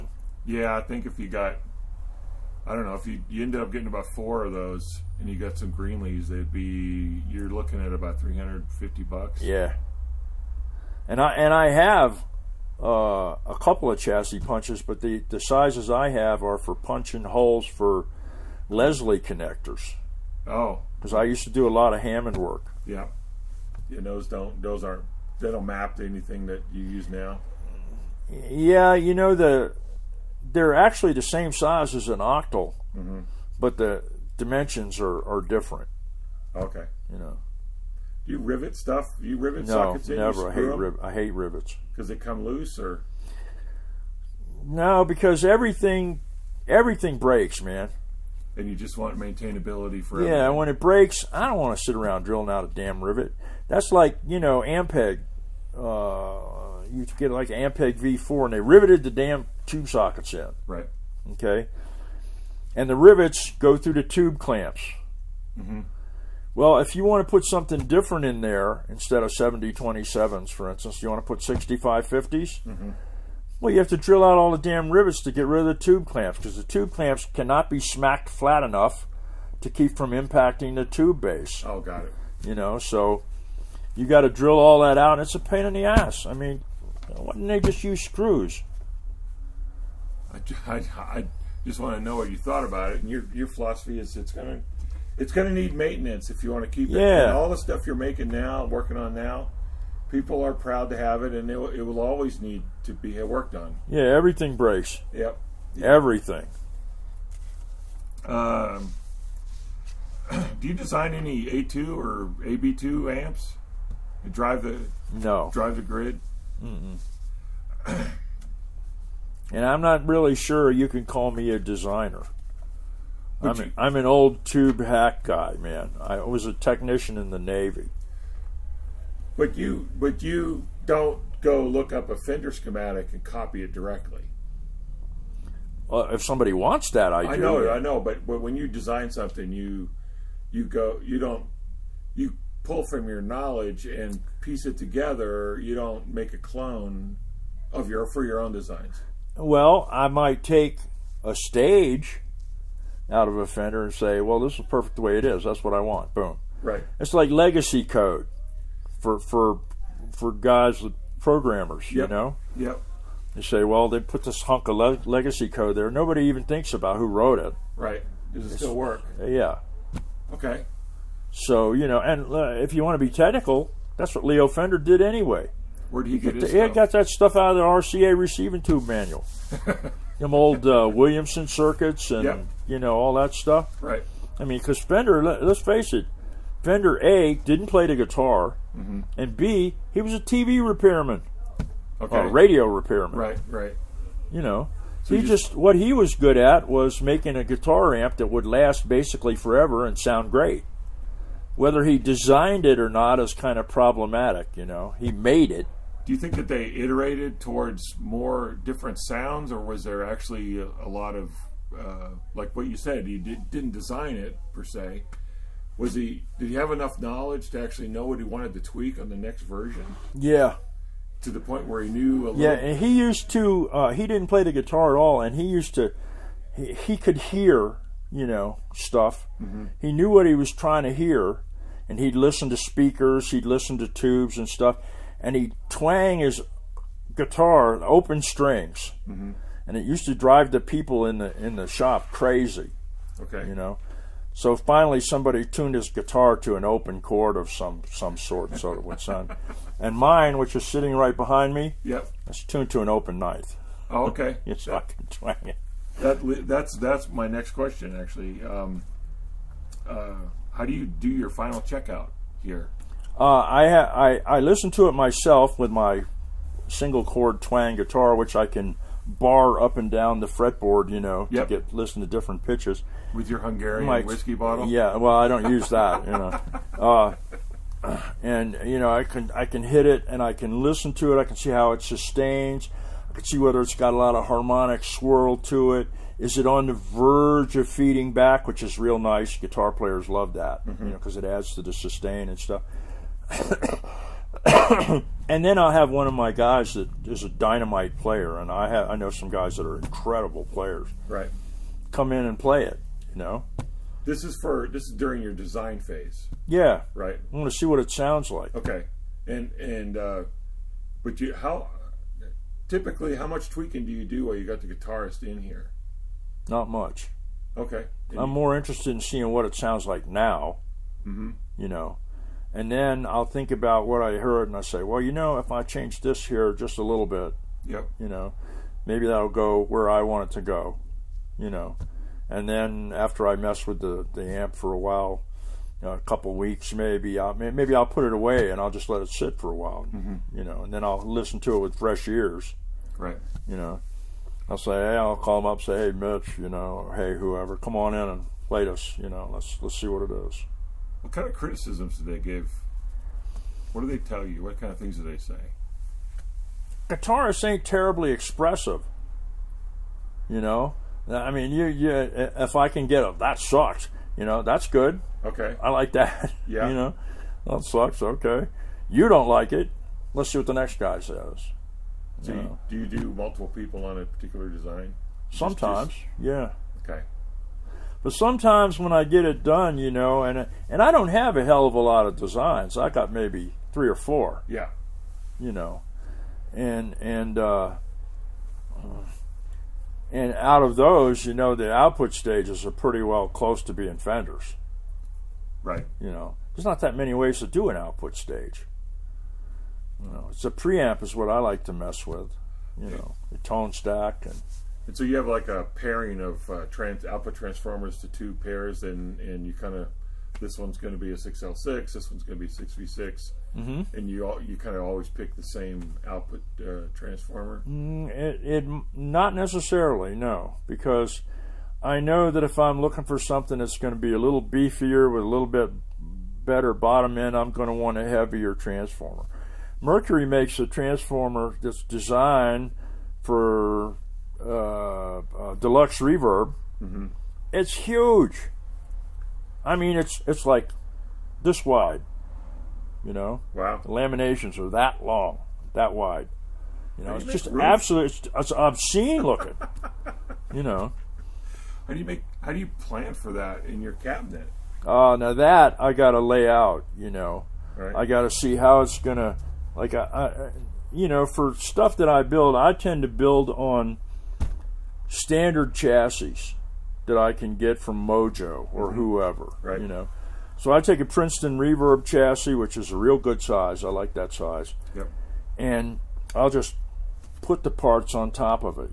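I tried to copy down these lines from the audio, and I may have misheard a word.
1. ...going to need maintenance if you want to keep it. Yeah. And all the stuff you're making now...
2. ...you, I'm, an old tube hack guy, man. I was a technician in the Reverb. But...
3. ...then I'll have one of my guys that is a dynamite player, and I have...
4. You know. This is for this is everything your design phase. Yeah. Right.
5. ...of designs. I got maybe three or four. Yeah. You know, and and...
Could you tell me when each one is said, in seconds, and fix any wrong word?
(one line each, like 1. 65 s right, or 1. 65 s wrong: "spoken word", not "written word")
1. 95 s right
2. 123 s wrong: "Navy", not "Reverb"
3. 295 s right
4. 303 s wrong: "during", not "everything"
5. 382 s right.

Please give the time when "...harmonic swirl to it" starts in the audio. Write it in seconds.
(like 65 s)
284 s.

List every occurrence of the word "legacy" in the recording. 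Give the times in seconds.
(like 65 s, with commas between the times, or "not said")
157 s, 165 s.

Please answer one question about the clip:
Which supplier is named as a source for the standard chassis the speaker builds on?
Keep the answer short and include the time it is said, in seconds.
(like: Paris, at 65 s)
Mojo, at 468 s.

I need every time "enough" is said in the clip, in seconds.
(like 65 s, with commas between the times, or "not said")
78 s, 216 s.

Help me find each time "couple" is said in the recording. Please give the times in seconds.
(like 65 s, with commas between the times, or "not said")
13 s, 335 s.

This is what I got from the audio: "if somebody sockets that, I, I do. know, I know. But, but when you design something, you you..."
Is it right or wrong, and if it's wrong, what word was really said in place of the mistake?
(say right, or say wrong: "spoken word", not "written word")
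wrong: "wants", not "sockets".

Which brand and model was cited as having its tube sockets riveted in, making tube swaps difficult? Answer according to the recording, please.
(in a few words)
Ampeg V4.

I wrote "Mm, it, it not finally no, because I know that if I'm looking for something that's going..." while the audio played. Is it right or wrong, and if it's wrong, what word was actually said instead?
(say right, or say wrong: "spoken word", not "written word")
wrong: "necessarily", not "finally".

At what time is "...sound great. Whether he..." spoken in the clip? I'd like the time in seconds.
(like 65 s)
199 s.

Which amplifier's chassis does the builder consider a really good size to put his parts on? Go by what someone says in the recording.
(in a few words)
Princeton Reverb.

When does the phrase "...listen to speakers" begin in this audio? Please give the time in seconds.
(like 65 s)
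232 s.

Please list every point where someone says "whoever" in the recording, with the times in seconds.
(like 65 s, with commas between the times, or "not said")
347 s, 468 s.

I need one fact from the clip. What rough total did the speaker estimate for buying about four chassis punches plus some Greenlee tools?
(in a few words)
$350.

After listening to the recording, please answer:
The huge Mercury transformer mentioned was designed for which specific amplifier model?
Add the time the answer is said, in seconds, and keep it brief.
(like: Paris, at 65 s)
Deluxe Reverb, at 435 s.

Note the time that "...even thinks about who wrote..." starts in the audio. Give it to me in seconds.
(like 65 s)
166 s.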